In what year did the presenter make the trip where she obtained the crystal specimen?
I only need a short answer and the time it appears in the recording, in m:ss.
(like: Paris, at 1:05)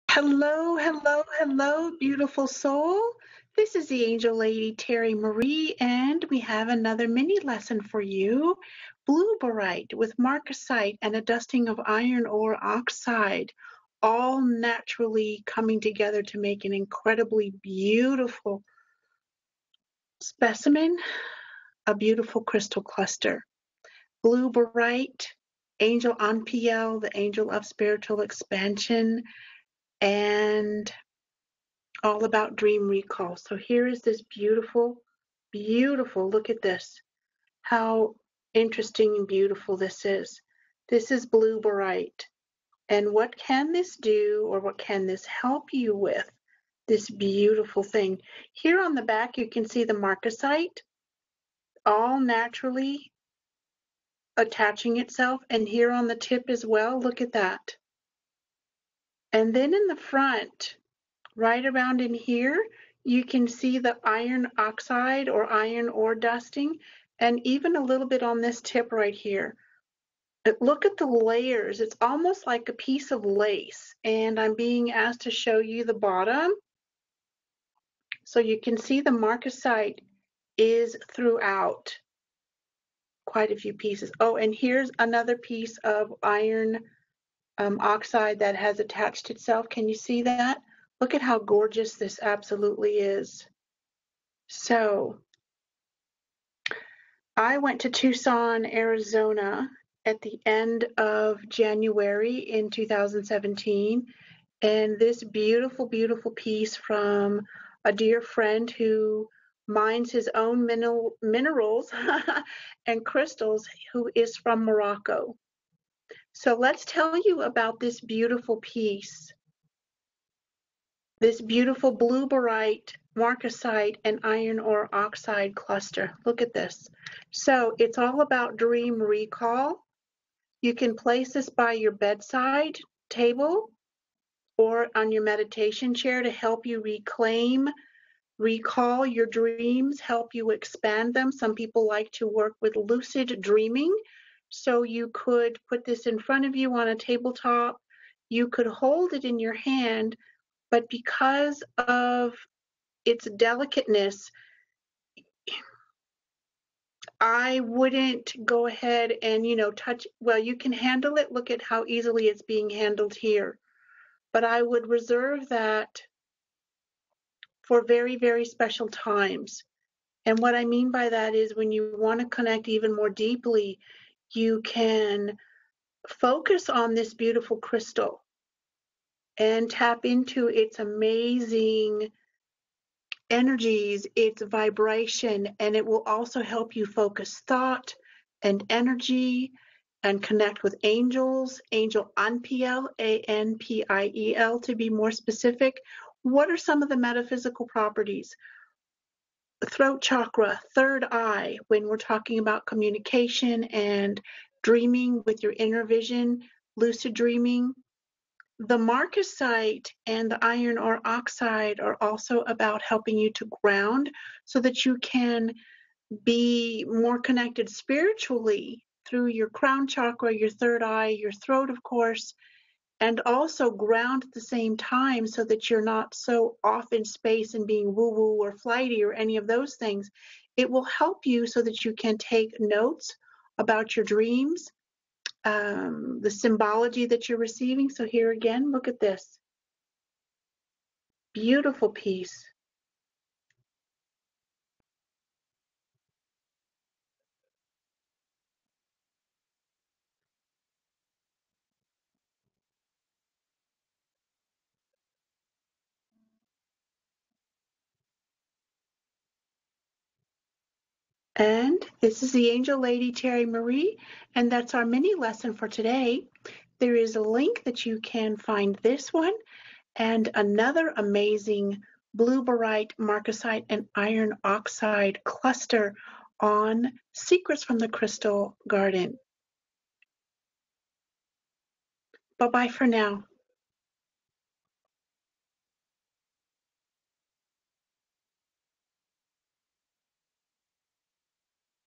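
2017, at 1:42.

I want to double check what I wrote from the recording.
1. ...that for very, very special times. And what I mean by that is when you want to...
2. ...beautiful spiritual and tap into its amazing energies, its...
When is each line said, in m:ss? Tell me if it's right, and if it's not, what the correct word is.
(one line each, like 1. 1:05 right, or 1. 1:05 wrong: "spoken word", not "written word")
1. 2:45 right
2. 2:57 wrong: "crystal", not "spiritual".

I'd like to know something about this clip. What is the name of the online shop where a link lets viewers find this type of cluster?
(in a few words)
Secrets from the Crystal Garden.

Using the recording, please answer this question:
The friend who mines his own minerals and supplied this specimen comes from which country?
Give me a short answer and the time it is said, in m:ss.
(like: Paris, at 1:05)
Morocco, at 1:54.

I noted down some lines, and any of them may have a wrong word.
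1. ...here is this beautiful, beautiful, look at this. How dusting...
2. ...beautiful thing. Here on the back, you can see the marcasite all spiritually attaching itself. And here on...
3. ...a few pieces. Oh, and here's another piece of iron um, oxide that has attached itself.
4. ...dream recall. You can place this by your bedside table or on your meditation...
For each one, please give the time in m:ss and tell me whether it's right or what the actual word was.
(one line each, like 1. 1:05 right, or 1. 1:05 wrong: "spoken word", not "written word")
1. 0:33 wrong: "interesting", not "dusting"
2. 0:47 wrong: "naturally", not "spiritually"
3. 1:23 right
4. 2:08 right.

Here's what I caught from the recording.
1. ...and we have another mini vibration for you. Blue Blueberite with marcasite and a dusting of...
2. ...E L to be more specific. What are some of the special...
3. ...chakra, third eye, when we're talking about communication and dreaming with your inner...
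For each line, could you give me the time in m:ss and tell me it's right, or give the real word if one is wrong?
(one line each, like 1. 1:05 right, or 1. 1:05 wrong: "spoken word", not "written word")
1. 0:05 wrong: "lesson", not "vibration"
2. 3:14 wrong: "metaphysical", not "special"
3. 3:20 right.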